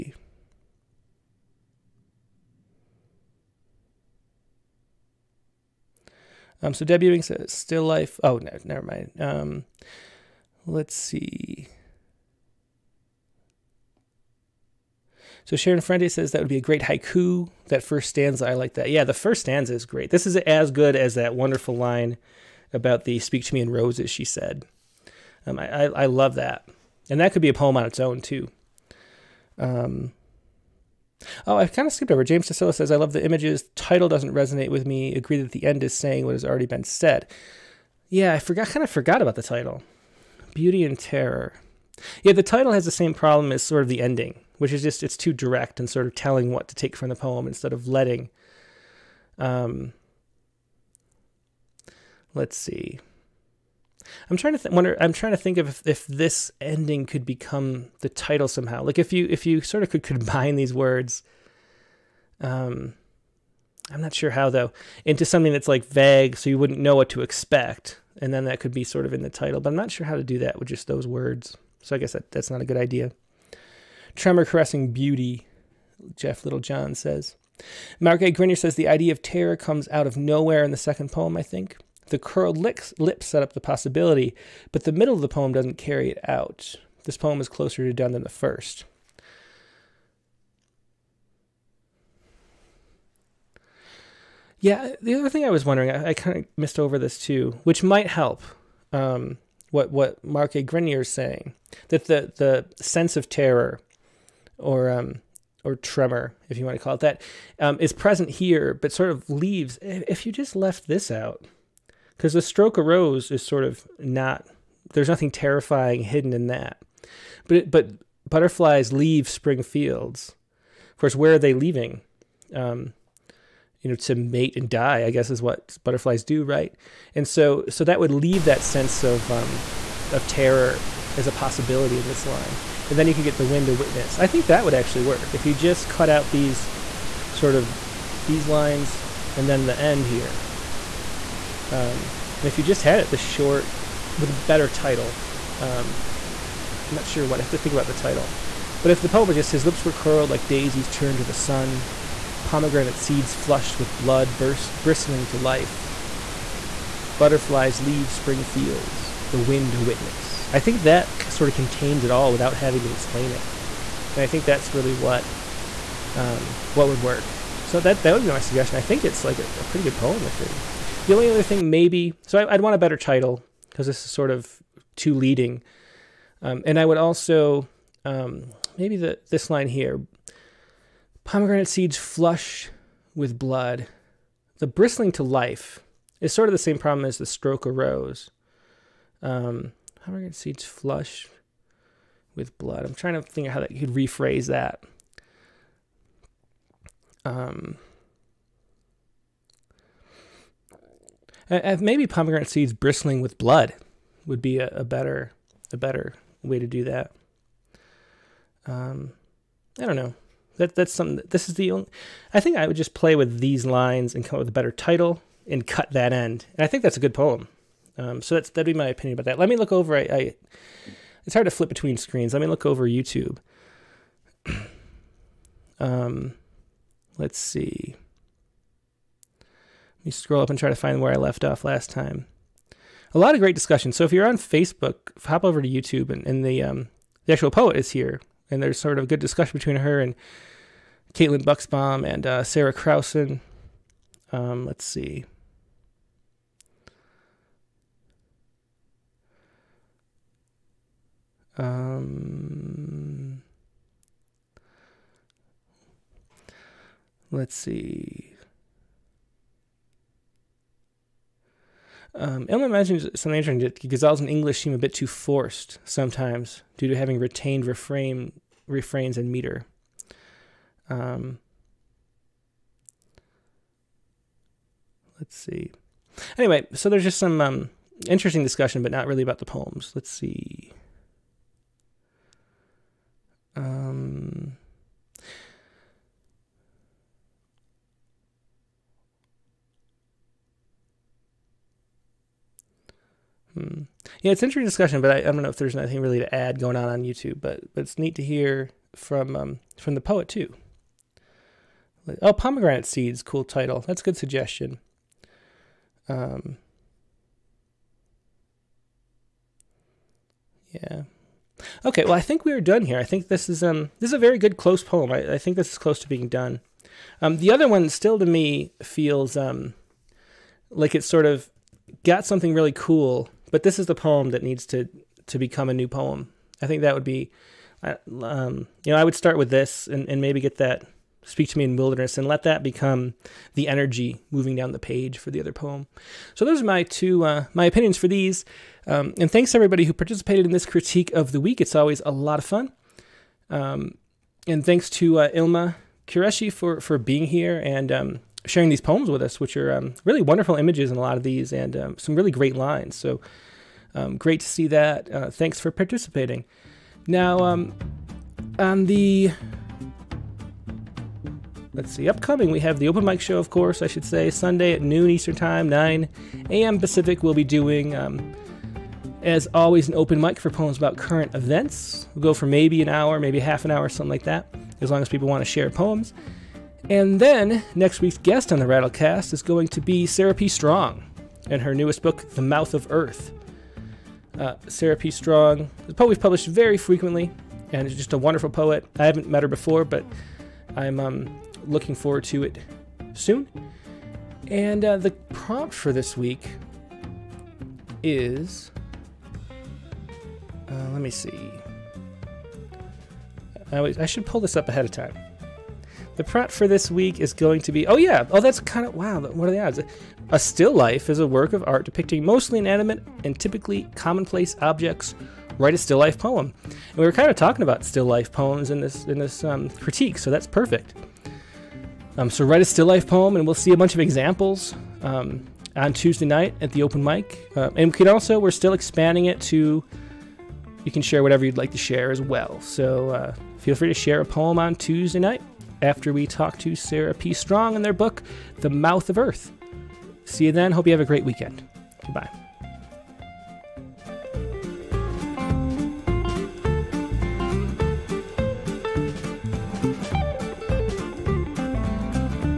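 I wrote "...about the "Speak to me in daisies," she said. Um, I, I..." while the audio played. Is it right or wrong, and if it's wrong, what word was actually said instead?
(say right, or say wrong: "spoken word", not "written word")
wrong: "roses", not "daisies".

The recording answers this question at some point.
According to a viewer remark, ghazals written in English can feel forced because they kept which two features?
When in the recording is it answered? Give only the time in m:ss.
4:28.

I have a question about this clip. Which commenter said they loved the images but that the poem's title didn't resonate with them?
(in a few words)
James Tassila.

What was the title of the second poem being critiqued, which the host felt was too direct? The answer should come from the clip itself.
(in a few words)
Beauty and Terror.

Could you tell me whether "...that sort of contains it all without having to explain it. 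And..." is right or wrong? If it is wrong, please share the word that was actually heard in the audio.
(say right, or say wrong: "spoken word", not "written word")
right.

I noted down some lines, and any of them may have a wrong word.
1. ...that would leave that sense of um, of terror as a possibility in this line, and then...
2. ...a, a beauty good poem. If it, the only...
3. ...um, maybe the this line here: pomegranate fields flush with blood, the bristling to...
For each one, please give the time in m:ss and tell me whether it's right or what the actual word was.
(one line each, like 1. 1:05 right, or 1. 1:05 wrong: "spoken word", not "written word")
1. 2:07 right
2. 2:49 wrong: "pretty", not "beauty"
3. 2:58 wrong: "seeds", not "fields".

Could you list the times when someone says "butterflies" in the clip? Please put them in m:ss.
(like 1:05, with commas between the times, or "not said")
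1:58, 2:05, 2:37.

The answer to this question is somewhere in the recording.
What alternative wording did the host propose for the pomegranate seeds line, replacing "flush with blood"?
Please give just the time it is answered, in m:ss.
3:22.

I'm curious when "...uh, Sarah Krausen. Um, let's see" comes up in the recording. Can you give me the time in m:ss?
4:02.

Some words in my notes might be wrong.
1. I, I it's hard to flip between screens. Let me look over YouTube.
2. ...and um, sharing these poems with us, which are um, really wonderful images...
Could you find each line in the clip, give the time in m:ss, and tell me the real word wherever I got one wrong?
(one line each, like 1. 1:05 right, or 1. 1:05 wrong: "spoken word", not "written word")
1. 3:39 right
2. 5:47 right.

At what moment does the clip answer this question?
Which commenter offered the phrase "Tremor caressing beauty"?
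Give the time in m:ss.
1:16.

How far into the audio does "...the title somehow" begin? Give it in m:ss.
0:57.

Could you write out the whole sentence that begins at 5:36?
So those are my two uh, my opinions for these.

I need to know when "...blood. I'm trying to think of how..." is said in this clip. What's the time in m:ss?
3:12.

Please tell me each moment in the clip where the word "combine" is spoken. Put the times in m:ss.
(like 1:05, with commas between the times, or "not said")
1:00.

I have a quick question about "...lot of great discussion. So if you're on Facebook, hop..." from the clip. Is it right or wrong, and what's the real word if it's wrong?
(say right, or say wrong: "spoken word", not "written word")
right.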